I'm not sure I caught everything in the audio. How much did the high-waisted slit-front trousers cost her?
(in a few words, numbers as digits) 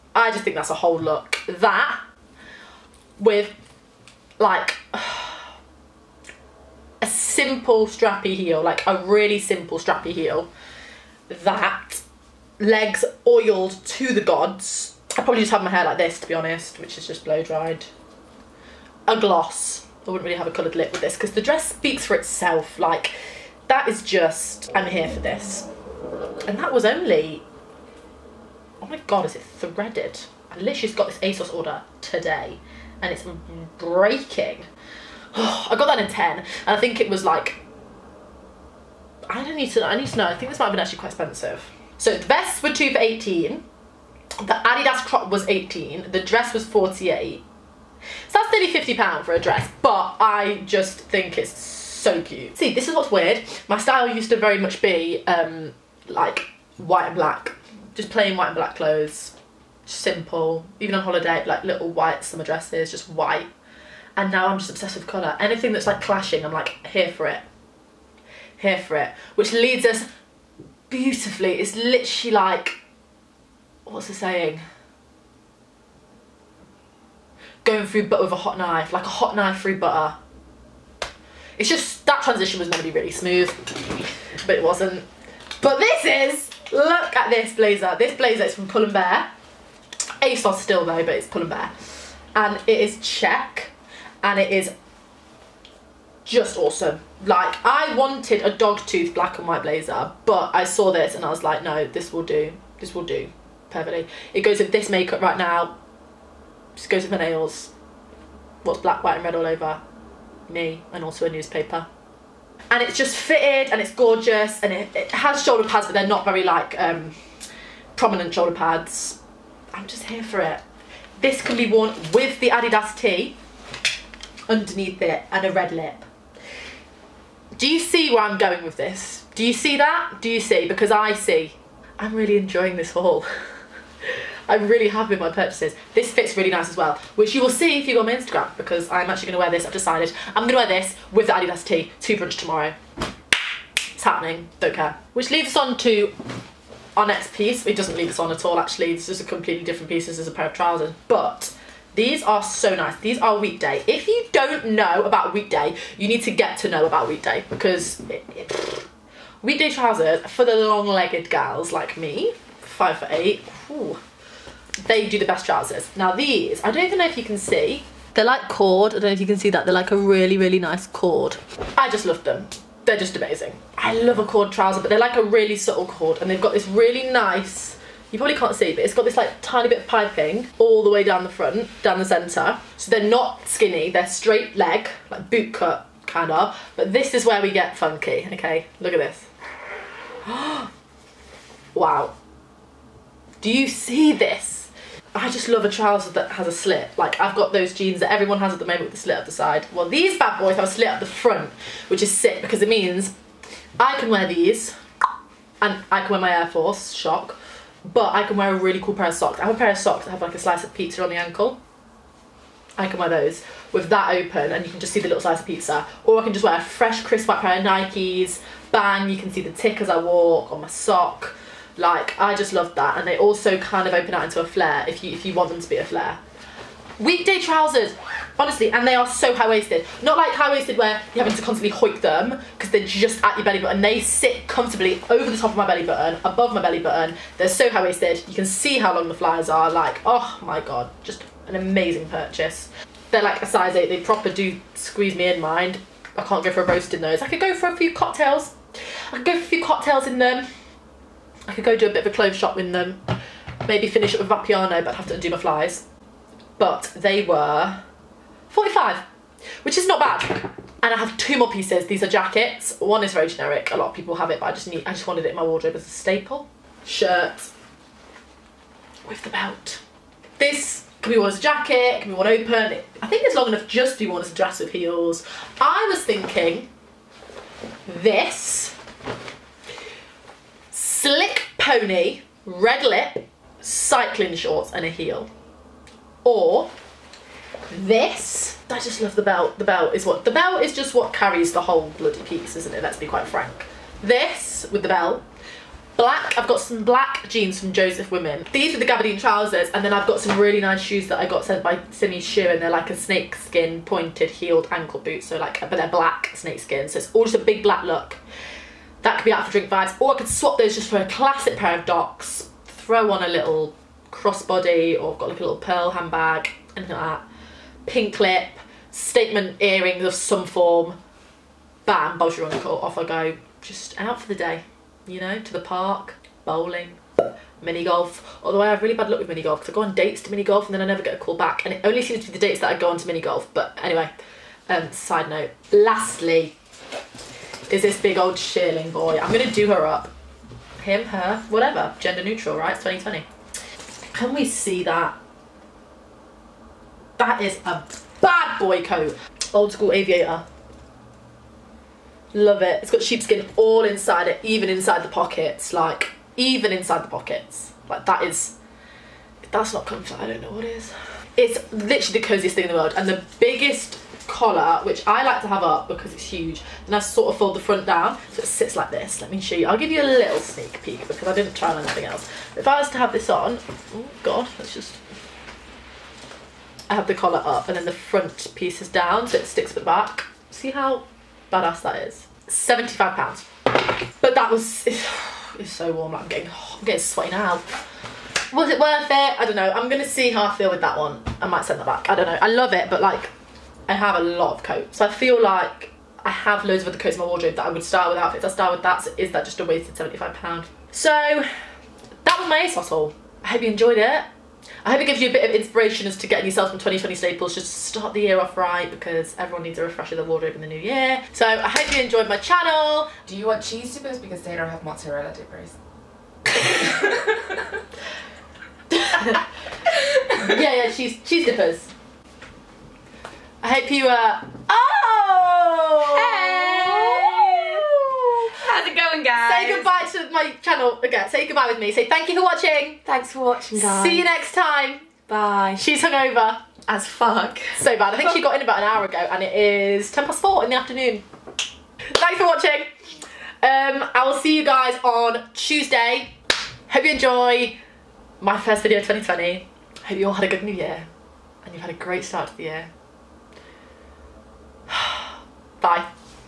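45.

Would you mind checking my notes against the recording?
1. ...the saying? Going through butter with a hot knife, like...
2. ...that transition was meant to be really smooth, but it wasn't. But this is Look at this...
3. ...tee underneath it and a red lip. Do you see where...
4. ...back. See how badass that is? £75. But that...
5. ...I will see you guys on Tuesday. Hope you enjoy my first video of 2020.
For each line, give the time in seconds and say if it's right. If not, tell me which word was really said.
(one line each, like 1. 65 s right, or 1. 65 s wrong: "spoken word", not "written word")
1. 74 s right
2. 82 s right
3. 122 s right
4. 379 s right
5. 444 s right.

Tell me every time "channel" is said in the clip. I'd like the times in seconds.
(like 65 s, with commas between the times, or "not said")
412 s, 430 s.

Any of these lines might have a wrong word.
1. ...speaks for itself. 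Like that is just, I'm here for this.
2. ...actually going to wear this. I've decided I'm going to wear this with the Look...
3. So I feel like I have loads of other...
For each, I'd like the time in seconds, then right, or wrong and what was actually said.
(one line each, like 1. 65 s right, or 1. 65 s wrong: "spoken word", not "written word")
1. 21 s right
2. 139 s wrong: "Adidas", not "Look"
3. 394 s right.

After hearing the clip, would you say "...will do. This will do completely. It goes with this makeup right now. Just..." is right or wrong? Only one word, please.
wrong.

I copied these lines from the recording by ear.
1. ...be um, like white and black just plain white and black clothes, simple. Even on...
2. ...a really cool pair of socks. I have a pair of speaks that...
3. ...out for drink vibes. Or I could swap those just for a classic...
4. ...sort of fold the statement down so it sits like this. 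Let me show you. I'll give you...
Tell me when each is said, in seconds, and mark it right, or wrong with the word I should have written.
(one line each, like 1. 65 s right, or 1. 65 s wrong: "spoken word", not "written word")
1. 54 s right
2. 208 s wrong: "socks", not "speaks"
3. 309 s right
4. 366 s wrong: "front", not "statement".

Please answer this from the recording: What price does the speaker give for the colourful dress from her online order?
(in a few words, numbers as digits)
£48.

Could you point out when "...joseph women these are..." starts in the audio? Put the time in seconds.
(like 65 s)
297 s.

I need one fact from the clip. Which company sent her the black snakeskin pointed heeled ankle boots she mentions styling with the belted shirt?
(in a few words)
Simmi shoe.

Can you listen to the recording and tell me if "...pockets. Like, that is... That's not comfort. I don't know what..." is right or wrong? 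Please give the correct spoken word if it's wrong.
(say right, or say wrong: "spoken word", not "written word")
right.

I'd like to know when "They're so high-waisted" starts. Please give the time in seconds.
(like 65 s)
237 s.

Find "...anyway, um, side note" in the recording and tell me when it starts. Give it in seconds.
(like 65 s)
333 s.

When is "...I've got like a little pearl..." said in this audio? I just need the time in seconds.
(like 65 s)
315 s.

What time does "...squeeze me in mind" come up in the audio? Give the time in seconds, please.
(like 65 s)
244 s.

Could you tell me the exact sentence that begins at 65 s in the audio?
Anything that's like clashing, I'm like here for it, here for it.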